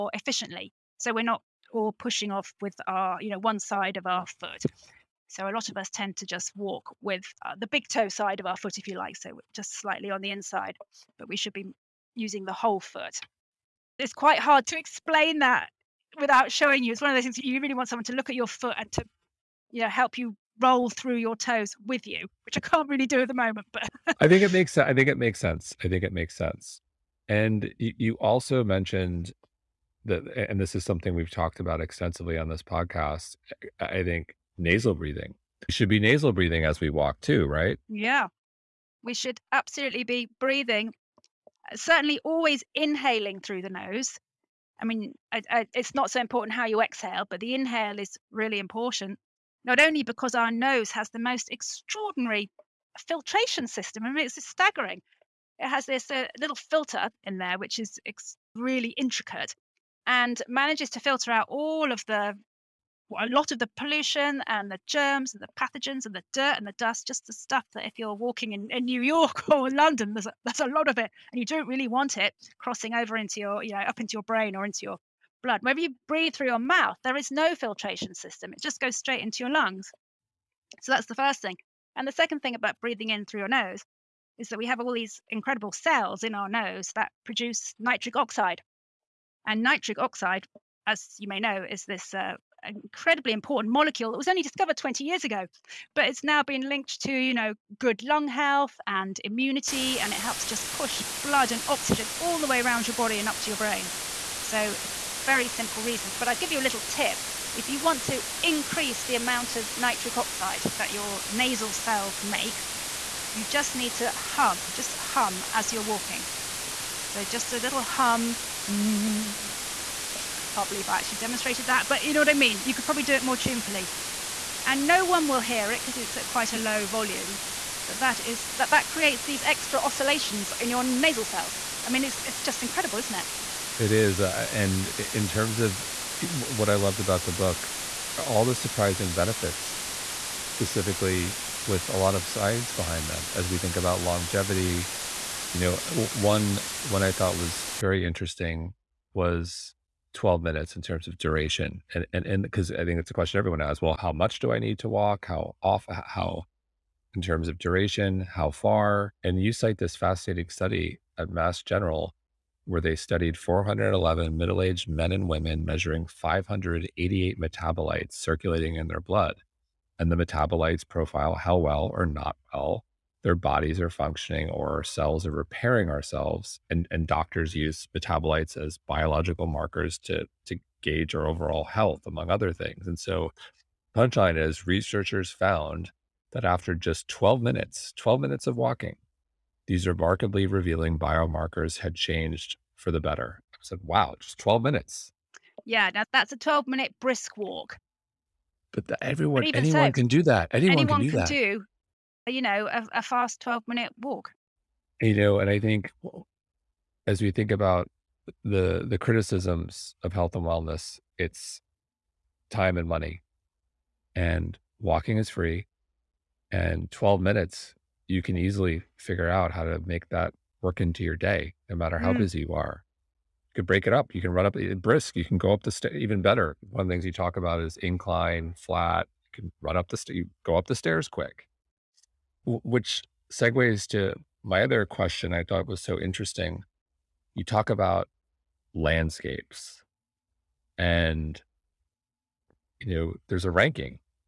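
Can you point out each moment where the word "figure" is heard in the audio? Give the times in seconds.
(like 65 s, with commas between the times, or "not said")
218 s.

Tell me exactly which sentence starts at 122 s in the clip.
You could probably do it more tunefully.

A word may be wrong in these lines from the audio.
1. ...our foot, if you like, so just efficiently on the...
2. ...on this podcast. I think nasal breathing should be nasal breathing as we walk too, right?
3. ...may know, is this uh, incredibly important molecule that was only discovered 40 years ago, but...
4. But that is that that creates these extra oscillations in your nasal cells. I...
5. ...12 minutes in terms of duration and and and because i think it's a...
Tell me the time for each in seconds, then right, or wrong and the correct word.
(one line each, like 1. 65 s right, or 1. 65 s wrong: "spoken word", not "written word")
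1. 8 s wrong: "slightly", not "efficiently"
2. 32 s right
3. 91 s wrong: "20", not "40"
4. 127 s right
5. 150 s right.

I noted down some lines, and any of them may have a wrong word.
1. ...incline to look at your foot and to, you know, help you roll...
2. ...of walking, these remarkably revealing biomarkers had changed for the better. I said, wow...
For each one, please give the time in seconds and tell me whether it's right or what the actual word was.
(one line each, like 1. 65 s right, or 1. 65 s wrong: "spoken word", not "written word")
1. 17 s wrong: "someone", not "incline"
2. 188 s right.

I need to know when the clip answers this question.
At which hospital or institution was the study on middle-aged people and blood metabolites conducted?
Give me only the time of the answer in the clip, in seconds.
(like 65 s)
161 s.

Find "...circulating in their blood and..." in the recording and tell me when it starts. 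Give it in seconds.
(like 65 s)
168 s.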